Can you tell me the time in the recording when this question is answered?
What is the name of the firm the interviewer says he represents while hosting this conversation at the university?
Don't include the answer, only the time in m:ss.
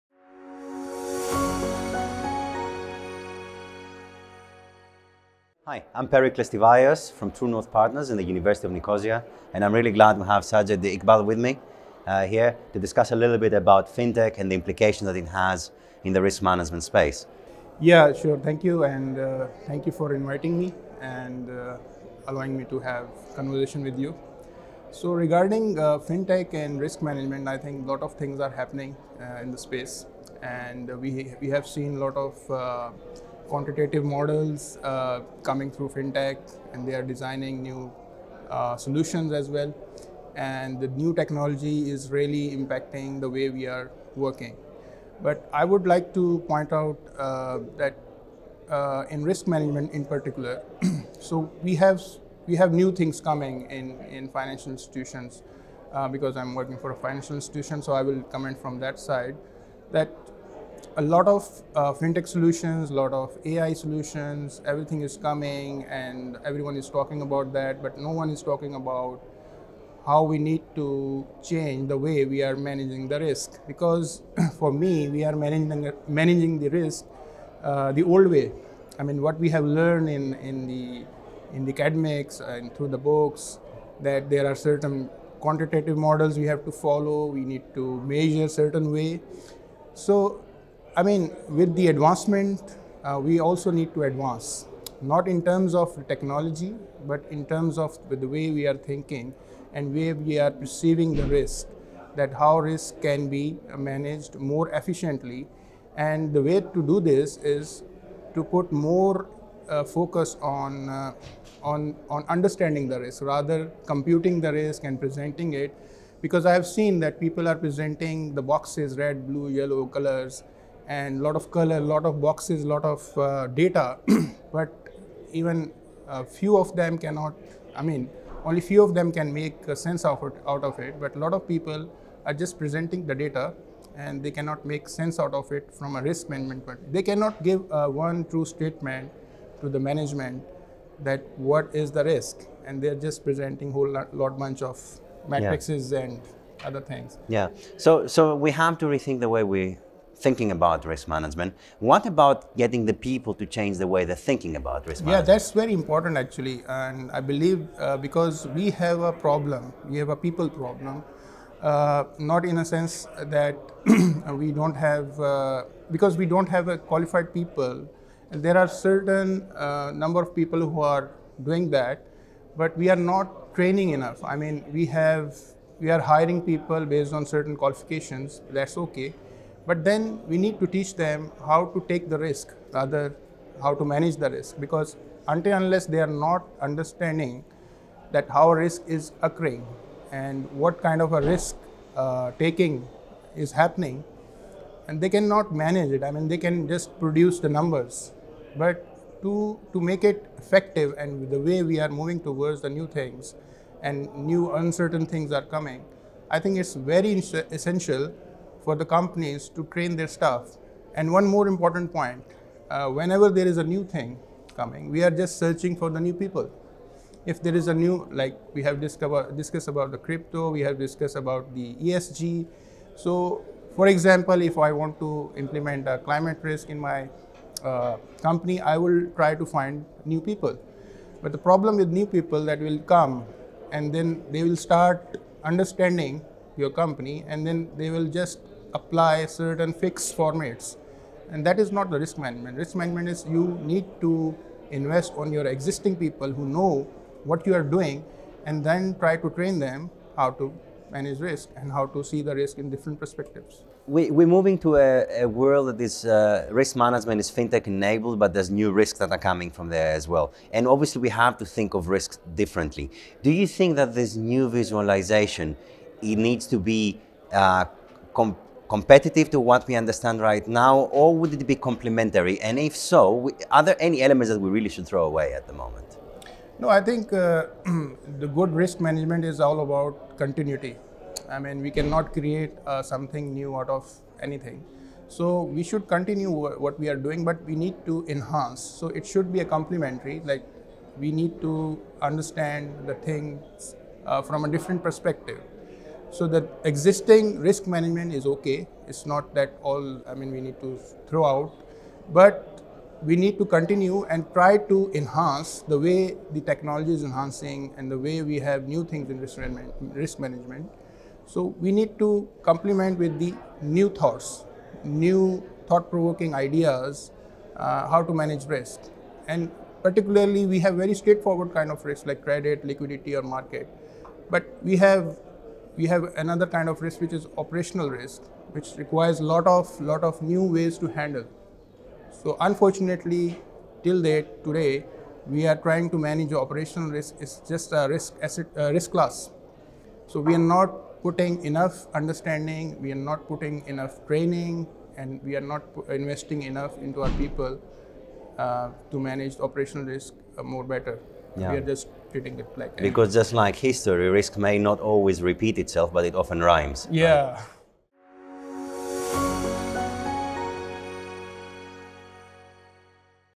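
0:07.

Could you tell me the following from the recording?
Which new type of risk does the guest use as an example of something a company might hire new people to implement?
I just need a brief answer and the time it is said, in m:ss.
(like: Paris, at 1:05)
Climate risk, at 3:45.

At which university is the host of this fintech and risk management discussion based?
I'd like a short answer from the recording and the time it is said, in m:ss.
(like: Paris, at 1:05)
University of Nicosia, at 0:08.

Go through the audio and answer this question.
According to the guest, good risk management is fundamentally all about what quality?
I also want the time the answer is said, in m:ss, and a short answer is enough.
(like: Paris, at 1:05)
Continuity, at 4:40.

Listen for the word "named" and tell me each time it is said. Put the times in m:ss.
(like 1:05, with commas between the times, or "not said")
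not said.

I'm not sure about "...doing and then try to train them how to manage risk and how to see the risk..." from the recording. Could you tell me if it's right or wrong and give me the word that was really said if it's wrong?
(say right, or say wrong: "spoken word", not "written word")
right.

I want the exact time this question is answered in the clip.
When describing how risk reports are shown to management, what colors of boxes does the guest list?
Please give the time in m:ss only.
1:58.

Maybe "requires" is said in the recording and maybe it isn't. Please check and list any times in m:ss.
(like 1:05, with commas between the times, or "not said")
5:28.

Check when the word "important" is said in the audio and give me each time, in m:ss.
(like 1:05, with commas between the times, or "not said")
2:35, 3:31.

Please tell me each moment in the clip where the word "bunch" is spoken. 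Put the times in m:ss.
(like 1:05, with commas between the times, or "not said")
2:24.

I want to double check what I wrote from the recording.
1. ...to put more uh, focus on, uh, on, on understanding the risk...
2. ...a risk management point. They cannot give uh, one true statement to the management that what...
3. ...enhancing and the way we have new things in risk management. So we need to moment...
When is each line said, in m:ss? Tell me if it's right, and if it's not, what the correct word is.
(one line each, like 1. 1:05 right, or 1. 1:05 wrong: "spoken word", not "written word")
1. 1:48 right
2. 2:15 right
3. 5:07 wrong: "complement", not "moment".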